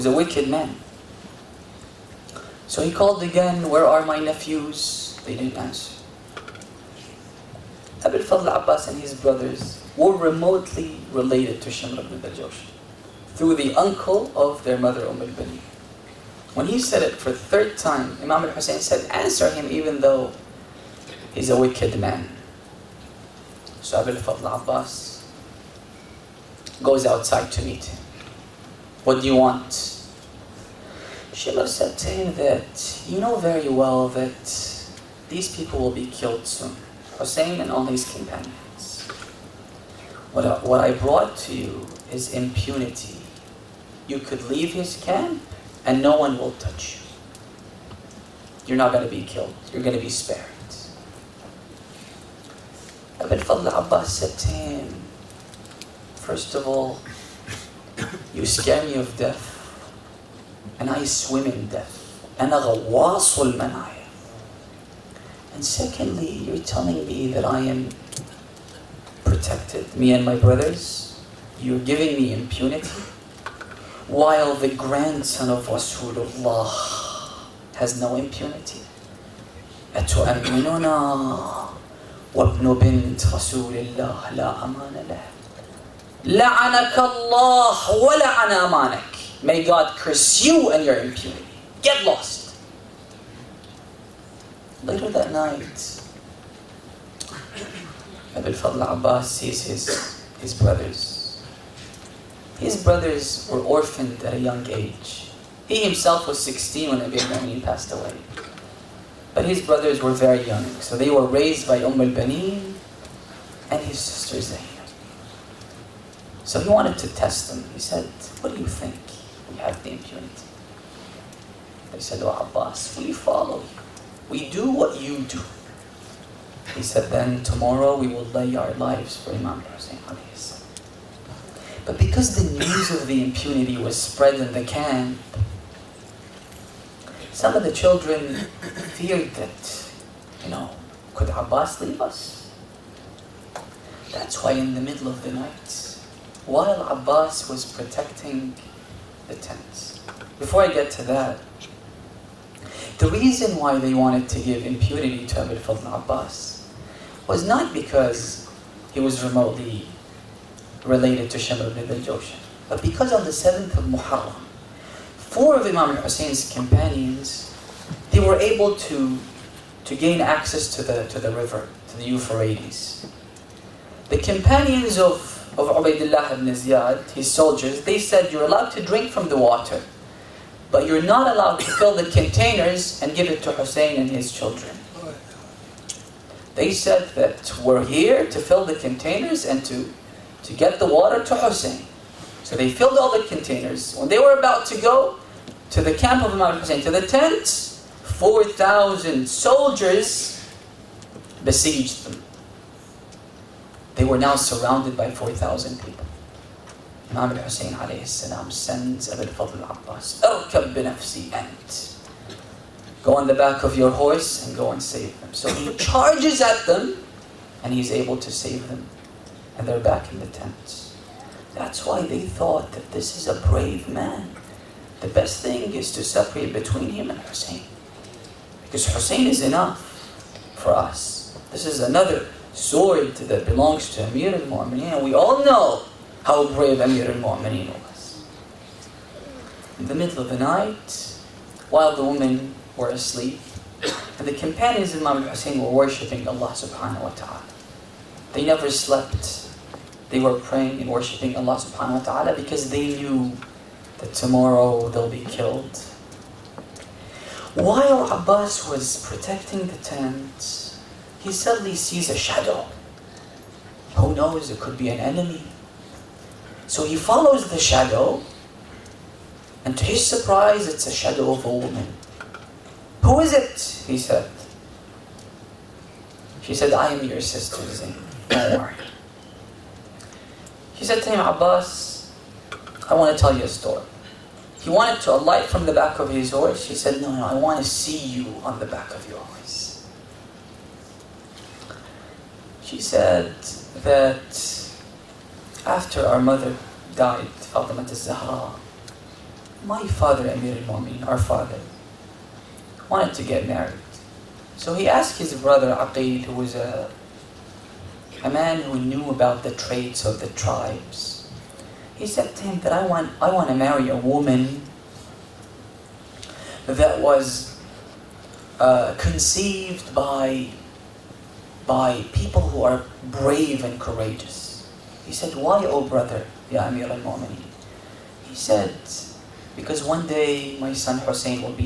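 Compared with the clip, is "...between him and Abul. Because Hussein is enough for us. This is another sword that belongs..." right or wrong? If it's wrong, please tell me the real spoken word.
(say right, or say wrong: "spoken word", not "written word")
wrong: "Hussein", not "Abul".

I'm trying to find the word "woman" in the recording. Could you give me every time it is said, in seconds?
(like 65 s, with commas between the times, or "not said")
271 s, 313 s.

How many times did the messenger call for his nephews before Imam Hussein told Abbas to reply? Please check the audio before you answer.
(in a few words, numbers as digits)
3.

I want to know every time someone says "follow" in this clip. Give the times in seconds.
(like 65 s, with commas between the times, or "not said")
123 s, 266 s.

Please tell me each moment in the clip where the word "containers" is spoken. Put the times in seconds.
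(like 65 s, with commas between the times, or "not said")
182 s, 188 s, 193 s.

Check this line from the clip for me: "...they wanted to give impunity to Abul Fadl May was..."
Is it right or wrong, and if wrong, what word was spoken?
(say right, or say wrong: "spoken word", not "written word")
wrong: "Abbas", not "May".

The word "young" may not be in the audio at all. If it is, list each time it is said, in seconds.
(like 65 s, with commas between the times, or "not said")
104 s, 110 s.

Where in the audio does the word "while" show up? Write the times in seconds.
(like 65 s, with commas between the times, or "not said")
74 s, 146 s, 241 s, 257 s.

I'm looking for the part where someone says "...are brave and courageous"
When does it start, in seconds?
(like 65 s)
322 s.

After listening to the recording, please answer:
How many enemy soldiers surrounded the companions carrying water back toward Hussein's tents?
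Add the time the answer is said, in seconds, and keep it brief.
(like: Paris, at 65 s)
4,000, at 198 s.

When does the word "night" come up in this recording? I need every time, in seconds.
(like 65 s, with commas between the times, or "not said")
95 s, 145 s, 240 s.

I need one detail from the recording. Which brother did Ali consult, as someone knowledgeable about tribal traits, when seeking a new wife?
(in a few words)
Aqil.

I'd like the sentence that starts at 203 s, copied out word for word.
They were now surrounded by 4,000 people.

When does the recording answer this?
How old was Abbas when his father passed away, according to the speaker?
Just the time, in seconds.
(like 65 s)
106 s.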